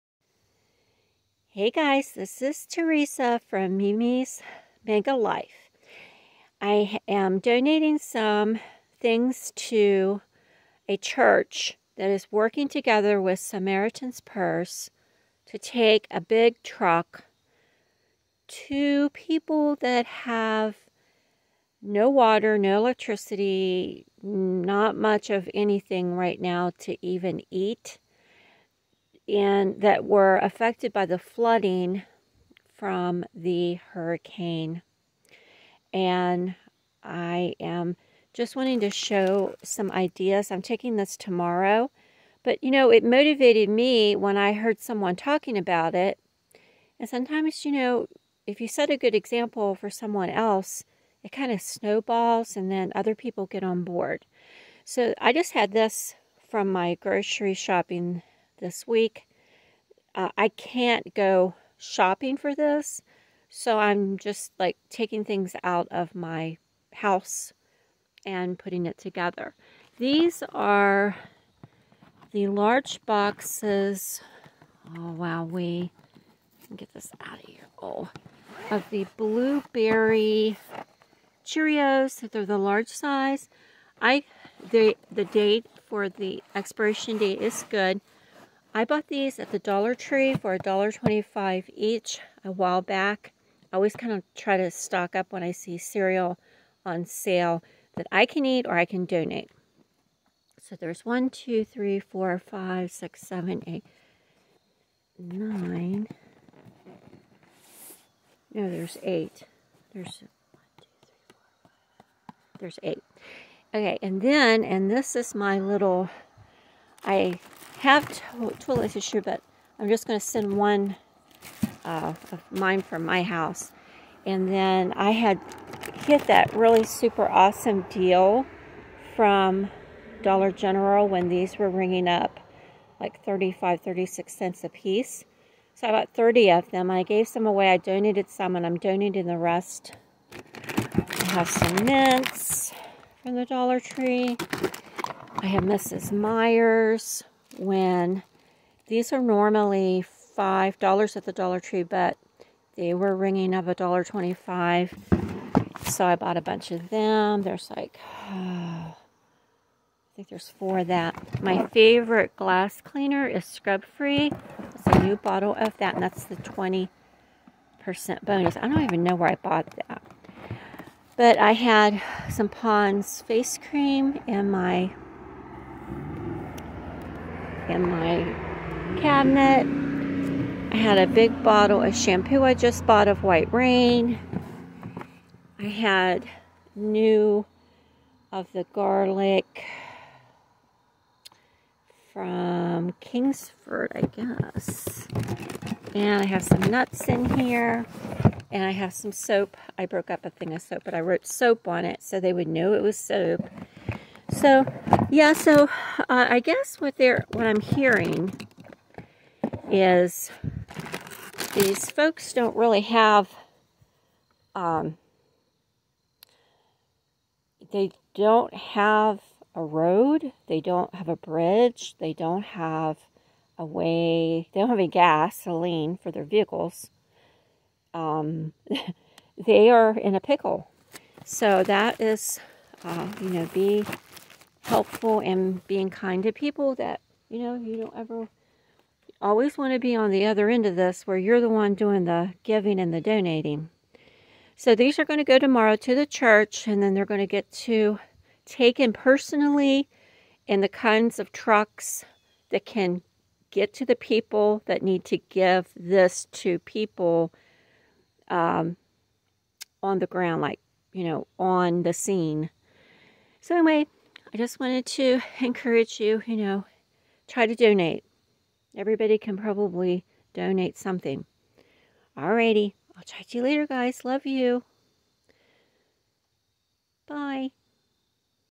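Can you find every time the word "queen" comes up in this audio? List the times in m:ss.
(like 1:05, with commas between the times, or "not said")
not said.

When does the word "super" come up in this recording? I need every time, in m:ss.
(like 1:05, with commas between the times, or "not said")
2:06.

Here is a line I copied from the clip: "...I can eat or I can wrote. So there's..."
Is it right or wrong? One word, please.
wrong.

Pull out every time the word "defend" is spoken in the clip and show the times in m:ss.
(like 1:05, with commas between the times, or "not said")
not said.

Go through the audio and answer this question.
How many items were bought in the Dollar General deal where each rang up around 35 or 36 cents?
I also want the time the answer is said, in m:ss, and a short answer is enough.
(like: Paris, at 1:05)
30, at 2:16.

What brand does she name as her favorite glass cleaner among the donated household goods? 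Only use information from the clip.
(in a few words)
Scrub Free.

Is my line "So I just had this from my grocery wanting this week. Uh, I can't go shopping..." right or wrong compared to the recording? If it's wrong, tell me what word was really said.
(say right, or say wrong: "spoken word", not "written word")
wrong: "shopping", not "wanting".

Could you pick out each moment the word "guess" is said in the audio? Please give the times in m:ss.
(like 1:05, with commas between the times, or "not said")
3:14, 3:26.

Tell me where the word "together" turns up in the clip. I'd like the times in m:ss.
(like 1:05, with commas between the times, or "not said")
0:12, 1:08.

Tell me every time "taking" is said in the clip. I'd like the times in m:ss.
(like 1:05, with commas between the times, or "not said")
0:40, 1:04.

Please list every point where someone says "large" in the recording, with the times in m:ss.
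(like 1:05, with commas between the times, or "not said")
1:12, 1:22.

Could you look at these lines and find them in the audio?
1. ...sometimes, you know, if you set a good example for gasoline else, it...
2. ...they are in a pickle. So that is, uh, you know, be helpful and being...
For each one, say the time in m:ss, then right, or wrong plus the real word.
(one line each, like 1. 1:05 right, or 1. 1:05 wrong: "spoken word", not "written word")
1. 0:47 wrong: "someone", not "gasoline"
2. 3:49 right.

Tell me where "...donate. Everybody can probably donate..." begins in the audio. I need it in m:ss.
4:27.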